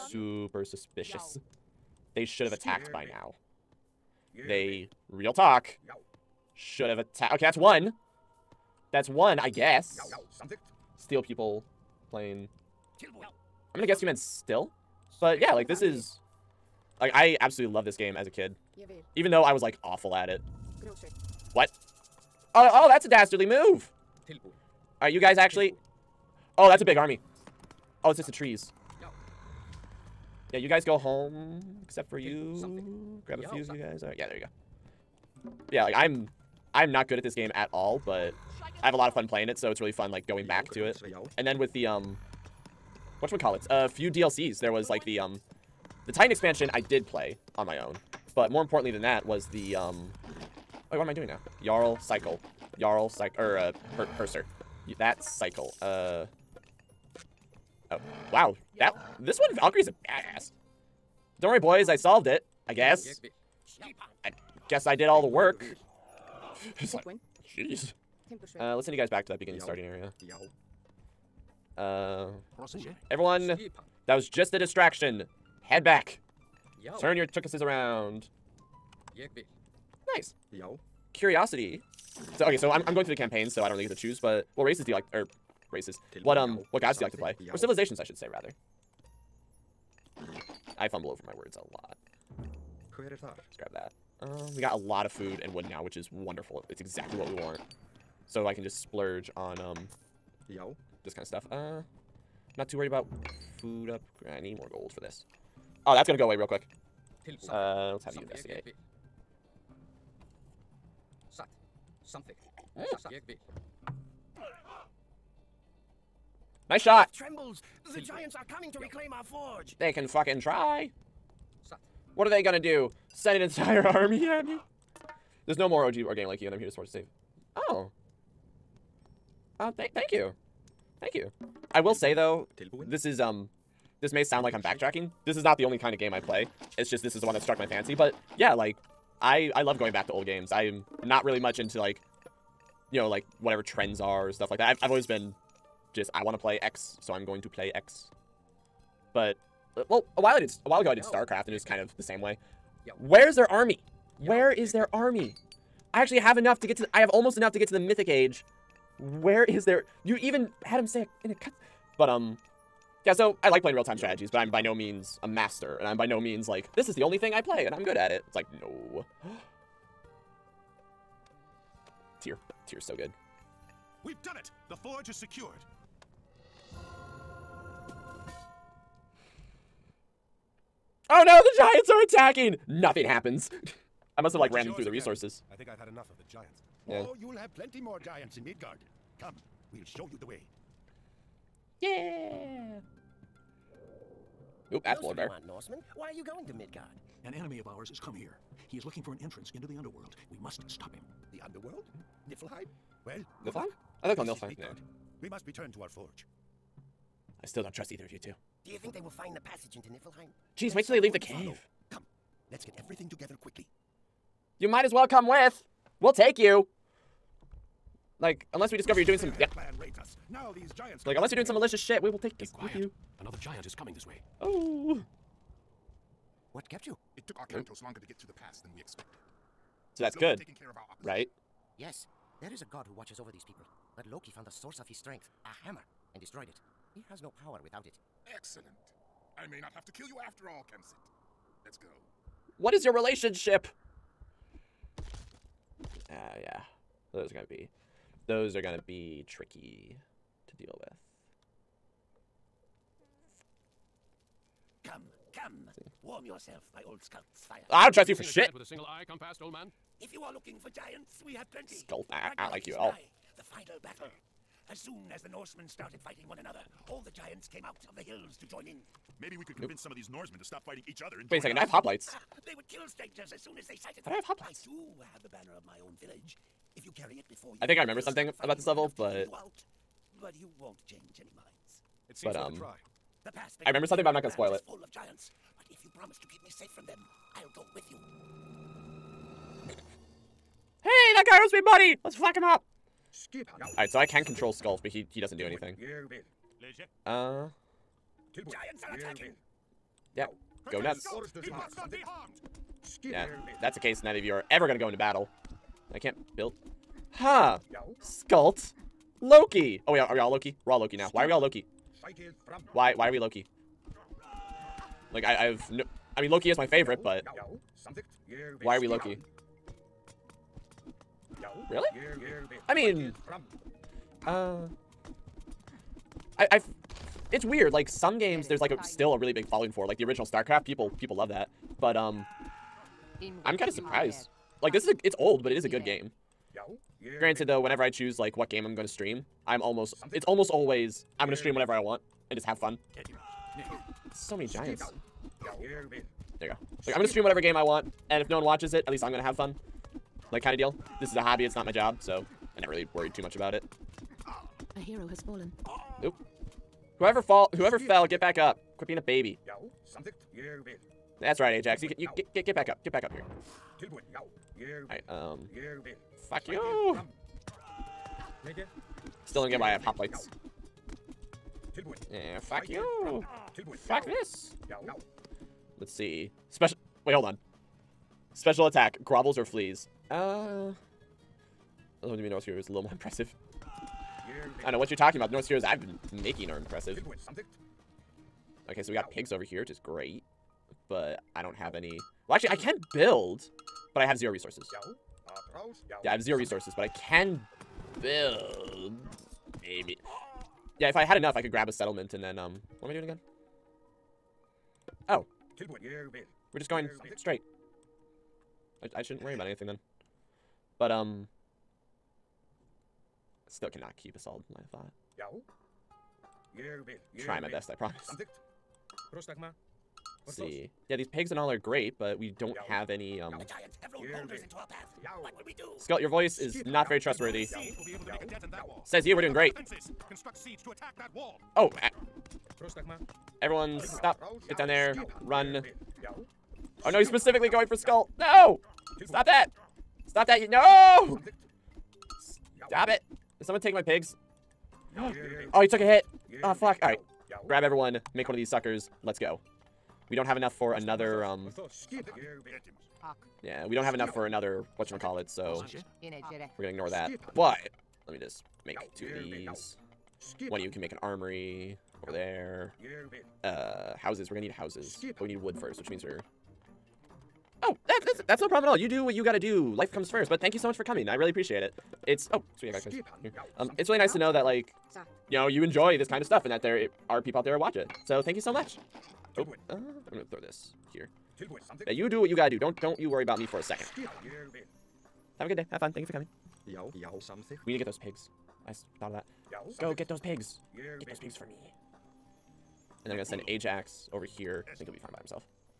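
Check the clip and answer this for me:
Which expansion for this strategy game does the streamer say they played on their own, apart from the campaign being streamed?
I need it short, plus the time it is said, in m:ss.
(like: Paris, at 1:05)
The Titan expansion, at 0:46.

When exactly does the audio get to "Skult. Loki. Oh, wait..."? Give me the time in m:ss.
5:08.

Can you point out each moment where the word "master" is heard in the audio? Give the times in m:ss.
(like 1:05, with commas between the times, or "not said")
2:45.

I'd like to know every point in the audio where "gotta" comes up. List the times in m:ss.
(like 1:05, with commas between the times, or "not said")
7:49, 8:02.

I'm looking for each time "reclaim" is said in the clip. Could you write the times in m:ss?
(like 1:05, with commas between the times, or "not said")
1:58.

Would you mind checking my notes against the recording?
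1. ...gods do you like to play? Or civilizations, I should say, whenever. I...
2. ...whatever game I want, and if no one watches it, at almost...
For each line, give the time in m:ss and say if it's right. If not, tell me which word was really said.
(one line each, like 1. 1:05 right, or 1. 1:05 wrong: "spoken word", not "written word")
1. 1:26 wrong: "rather", not "whenever"
2. 5:47 wrong: "least", not "almost".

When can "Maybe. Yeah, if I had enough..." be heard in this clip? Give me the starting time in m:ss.
6:39.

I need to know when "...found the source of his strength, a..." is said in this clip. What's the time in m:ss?
3:54.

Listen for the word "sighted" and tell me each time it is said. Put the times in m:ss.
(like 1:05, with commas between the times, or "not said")
4:33.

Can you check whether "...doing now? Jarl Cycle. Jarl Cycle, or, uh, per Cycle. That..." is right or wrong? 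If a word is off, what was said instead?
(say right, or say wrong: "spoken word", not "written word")
wrong: "Purser", not "Cycle".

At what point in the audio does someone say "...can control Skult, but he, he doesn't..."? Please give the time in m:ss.
4:54.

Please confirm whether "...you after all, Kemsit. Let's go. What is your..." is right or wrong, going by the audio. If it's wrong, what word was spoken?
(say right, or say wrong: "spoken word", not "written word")
right.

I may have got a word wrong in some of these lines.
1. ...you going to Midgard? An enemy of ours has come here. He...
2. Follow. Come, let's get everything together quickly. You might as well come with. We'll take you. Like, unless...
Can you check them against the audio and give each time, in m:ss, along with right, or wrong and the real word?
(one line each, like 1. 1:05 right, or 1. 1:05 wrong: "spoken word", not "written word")
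1. 3:16 right
2. 3:31 right.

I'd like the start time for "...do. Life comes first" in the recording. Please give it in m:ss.
7:49.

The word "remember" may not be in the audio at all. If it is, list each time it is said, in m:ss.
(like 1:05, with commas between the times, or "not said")
4:37, 4:43.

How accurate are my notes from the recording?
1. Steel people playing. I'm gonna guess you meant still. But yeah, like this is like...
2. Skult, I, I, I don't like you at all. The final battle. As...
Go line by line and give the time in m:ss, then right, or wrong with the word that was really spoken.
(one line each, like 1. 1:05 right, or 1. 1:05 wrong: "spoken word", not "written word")
1. 0:10 right
2. 4:21 right.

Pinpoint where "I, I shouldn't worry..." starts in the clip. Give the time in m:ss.
6:48.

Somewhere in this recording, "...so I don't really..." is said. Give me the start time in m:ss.
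1:23.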